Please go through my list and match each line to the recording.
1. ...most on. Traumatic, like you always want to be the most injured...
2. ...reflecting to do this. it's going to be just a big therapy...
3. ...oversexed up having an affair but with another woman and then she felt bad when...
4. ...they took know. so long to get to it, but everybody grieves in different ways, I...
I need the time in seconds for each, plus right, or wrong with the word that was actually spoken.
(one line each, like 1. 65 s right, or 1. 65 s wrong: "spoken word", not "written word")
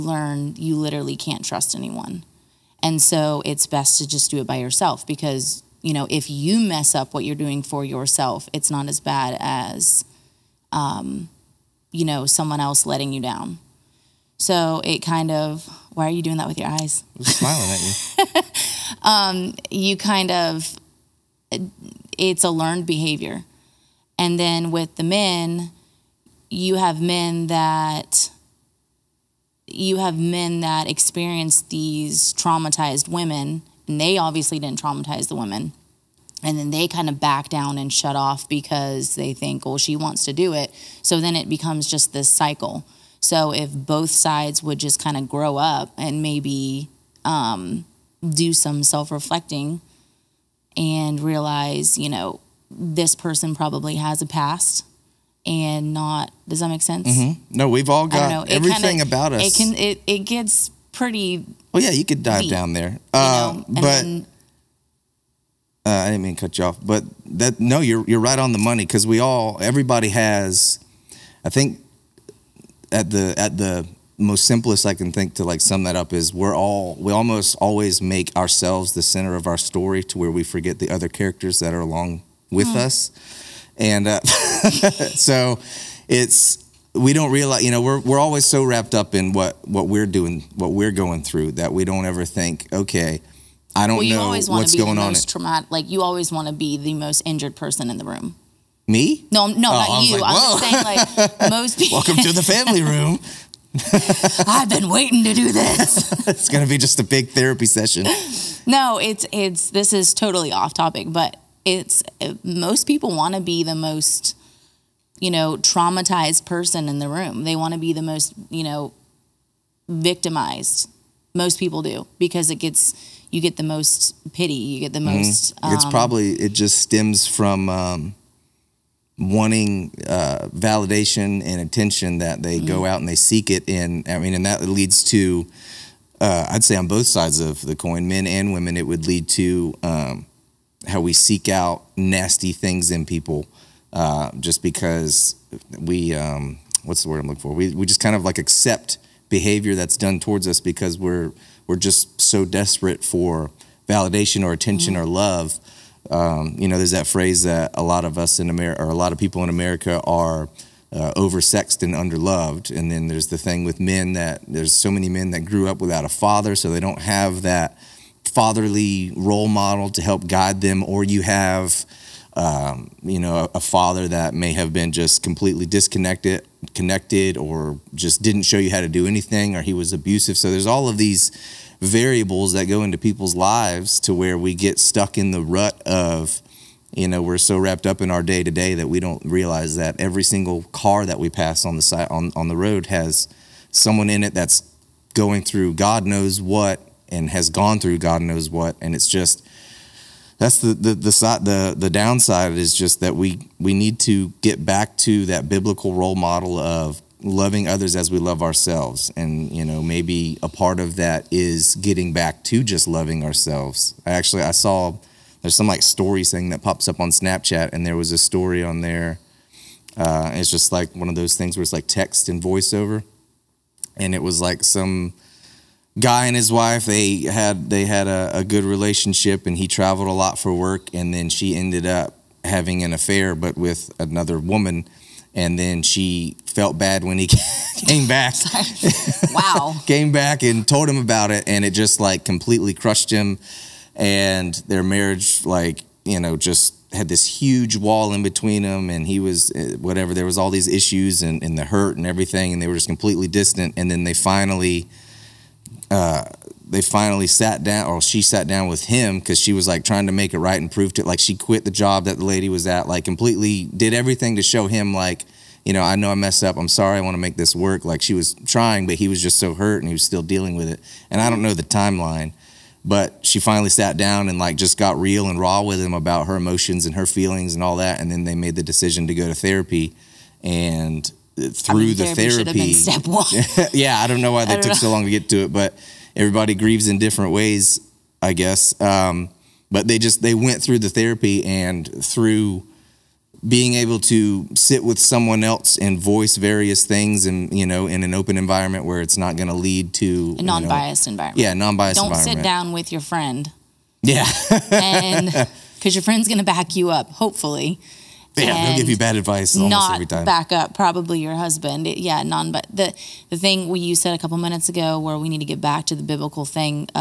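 1. 95 s right
2. 104 s wrong: "waiting", not "reflecting"
3. 231 s wrong: "ended", not "oversexed"
4. 284 s right.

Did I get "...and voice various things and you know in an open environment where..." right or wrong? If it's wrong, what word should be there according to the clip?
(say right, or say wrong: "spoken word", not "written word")
right.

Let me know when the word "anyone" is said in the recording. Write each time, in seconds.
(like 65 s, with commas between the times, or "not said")
1 s.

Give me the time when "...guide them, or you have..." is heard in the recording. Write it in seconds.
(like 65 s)
170 s.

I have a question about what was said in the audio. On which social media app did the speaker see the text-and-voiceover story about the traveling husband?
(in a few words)
Snapchat.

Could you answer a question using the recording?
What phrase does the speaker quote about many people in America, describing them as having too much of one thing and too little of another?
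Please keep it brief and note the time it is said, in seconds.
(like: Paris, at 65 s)
oversexed and underloved, at 161 s.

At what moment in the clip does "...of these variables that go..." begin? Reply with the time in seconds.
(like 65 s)
180 s.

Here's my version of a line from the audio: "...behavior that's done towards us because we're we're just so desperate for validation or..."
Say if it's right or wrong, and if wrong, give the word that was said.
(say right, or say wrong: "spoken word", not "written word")
right.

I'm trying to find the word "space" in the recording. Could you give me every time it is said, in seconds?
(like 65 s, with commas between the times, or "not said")
not said.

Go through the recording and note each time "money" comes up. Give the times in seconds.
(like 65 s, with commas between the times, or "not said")
68 s.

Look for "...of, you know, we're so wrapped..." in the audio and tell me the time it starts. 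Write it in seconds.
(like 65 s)
185 s.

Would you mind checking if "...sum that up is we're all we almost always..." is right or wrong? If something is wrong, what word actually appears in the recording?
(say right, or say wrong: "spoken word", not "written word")
right.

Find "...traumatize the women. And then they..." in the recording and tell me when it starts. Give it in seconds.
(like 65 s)
34 s.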